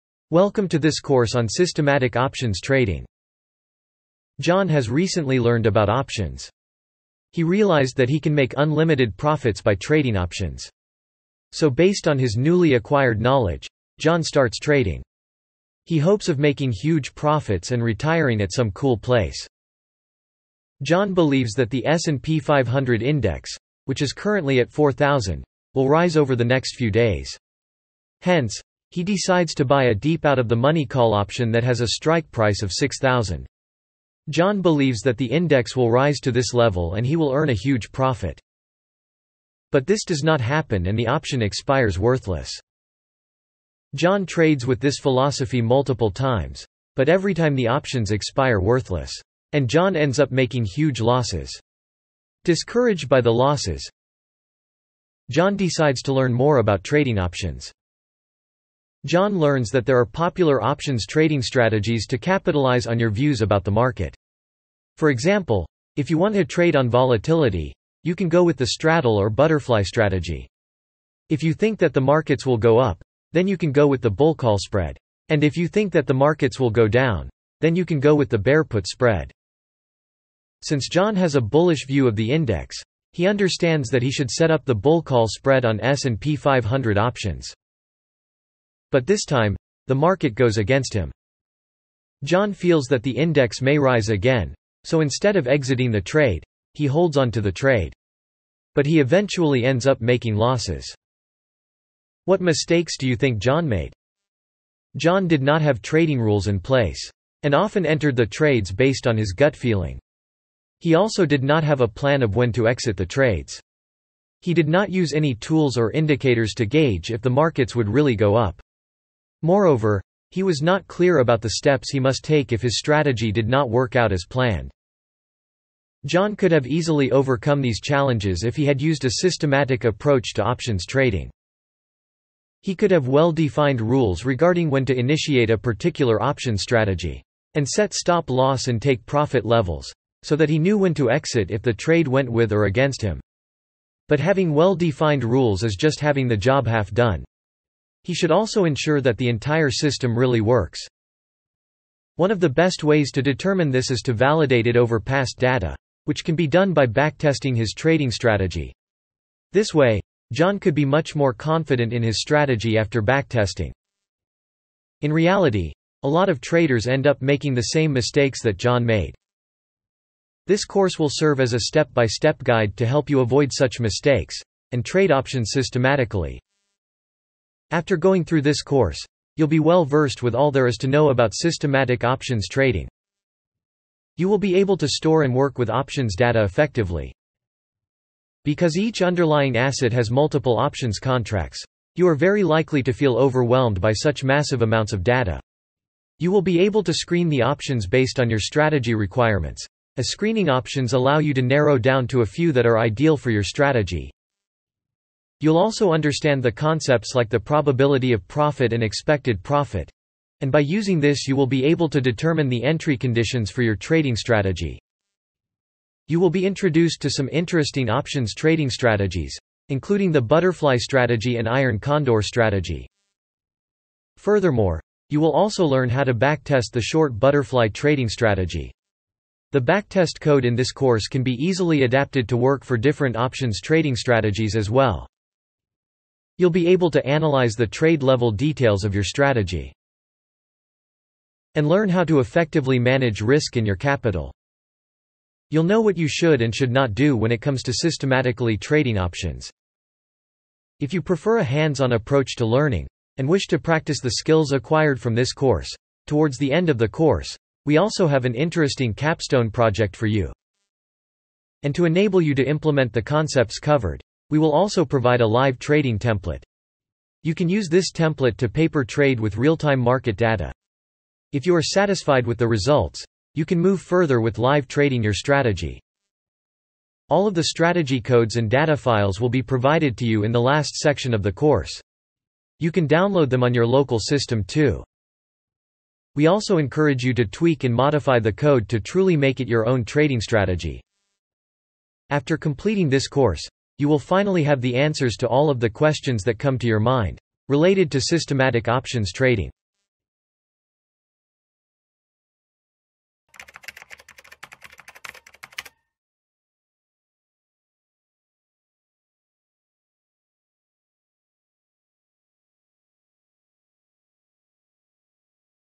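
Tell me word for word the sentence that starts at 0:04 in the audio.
John has recently learned about options.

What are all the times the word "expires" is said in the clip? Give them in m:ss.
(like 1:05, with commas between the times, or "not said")
0:41, 0:48.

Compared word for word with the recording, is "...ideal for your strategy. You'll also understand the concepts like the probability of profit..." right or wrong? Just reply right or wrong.
right.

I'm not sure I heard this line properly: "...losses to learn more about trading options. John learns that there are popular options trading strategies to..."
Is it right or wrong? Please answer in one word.
wrong.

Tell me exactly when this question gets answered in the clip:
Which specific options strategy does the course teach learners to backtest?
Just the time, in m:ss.
3:46.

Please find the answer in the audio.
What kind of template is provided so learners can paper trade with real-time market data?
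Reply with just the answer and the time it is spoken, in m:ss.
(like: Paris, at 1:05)
Live trading template, at 4:25.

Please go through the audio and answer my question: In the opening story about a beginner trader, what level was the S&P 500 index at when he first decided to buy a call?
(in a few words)
4000.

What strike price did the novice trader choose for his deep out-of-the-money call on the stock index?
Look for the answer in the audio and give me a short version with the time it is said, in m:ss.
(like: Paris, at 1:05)
6,000, at 0:32.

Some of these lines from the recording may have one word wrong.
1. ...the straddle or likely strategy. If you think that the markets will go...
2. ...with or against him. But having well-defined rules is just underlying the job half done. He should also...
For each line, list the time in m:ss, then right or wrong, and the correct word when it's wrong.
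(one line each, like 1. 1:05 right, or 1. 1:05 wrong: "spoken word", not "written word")
1. 1:08 wrong: "butterfly", not "likely"
2. 2:22 wrong: "having", not "underlying".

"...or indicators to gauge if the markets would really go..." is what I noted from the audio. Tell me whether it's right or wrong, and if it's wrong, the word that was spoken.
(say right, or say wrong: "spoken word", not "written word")
right.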